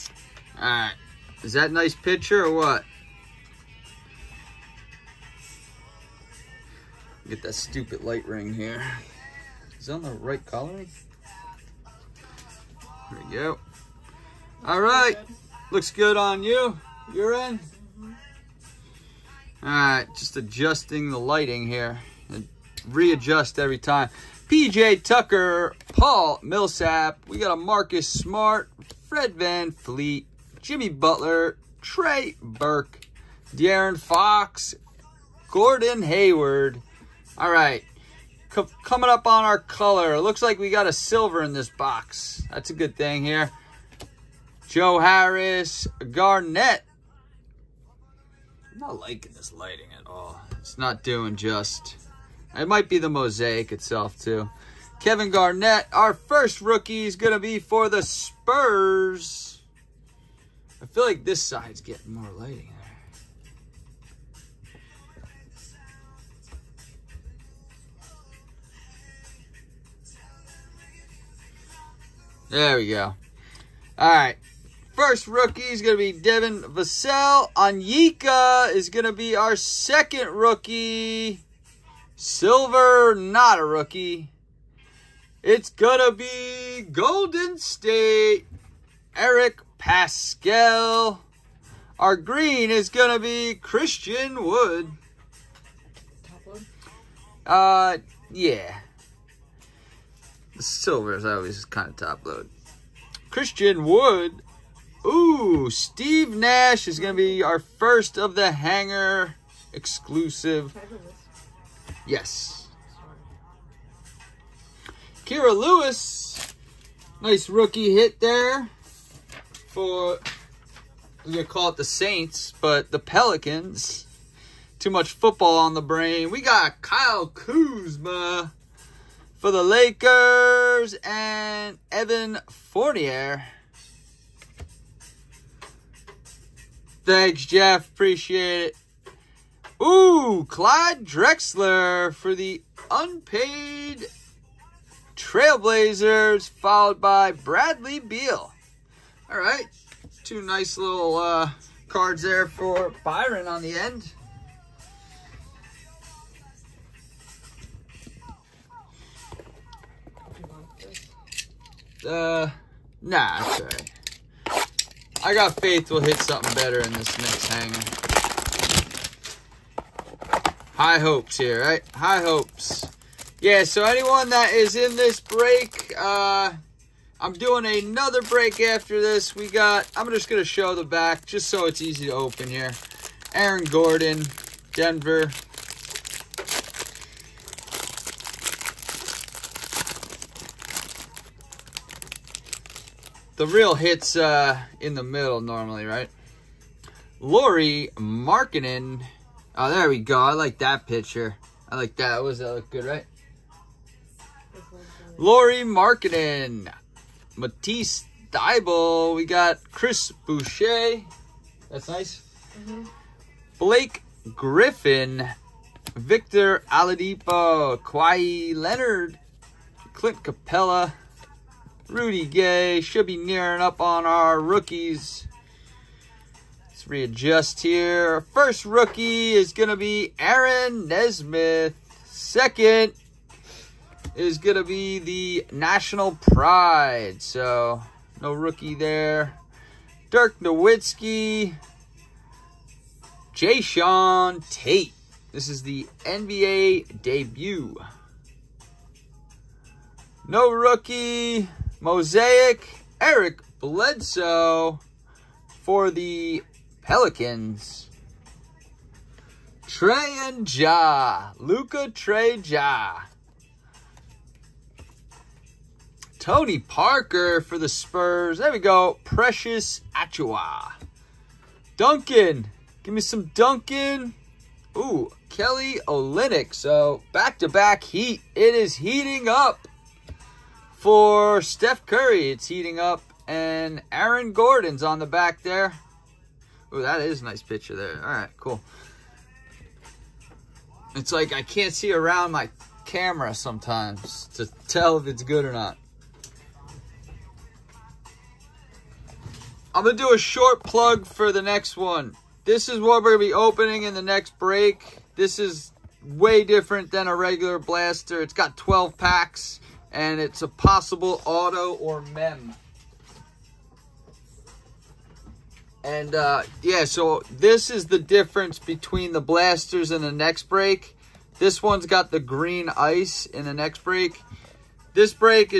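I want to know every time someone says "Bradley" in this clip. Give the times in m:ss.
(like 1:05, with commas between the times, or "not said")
2:27.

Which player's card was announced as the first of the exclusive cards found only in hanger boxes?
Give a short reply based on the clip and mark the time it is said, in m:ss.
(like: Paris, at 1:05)
Steve Nash, at 1:45.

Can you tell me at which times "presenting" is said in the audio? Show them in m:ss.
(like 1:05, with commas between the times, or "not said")
not said.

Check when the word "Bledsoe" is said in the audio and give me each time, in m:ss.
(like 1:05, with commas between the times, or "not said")
4:13.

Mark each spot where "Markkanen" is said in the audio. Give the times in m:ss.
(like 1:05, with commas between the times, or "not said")
3:17, 3:25.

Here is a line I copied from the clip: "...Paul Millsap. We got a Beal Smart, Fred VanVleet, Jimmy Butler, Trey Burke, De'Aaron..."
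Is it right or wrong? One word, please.
wrong.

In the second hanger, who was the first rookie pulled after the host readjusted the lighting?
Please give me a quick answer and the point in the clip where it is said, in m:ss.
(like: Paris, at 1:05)
Aaron Nesmith, at 3:50.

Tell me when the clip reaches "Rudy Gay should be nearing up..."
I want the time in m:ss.
3:41.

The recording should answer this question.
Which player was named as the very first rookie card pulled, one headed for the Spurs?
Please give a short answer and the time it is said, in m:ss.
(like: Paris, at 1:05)
Devin Vassell, at 1:16.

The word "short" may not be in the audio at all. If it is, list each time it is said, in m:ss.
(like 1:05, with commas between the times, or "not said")
5:00.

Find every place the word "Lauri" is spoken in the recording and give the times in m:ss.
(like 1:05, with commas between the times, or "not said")
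3:17, 3:25.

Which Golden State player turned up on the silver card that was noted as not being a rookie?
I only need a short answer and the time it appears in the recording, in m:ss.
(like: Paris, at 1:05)
Eric Paschall, at 1:29.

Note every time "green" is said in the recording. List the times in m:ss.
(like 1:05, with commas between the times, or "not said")
1:32, 5:22.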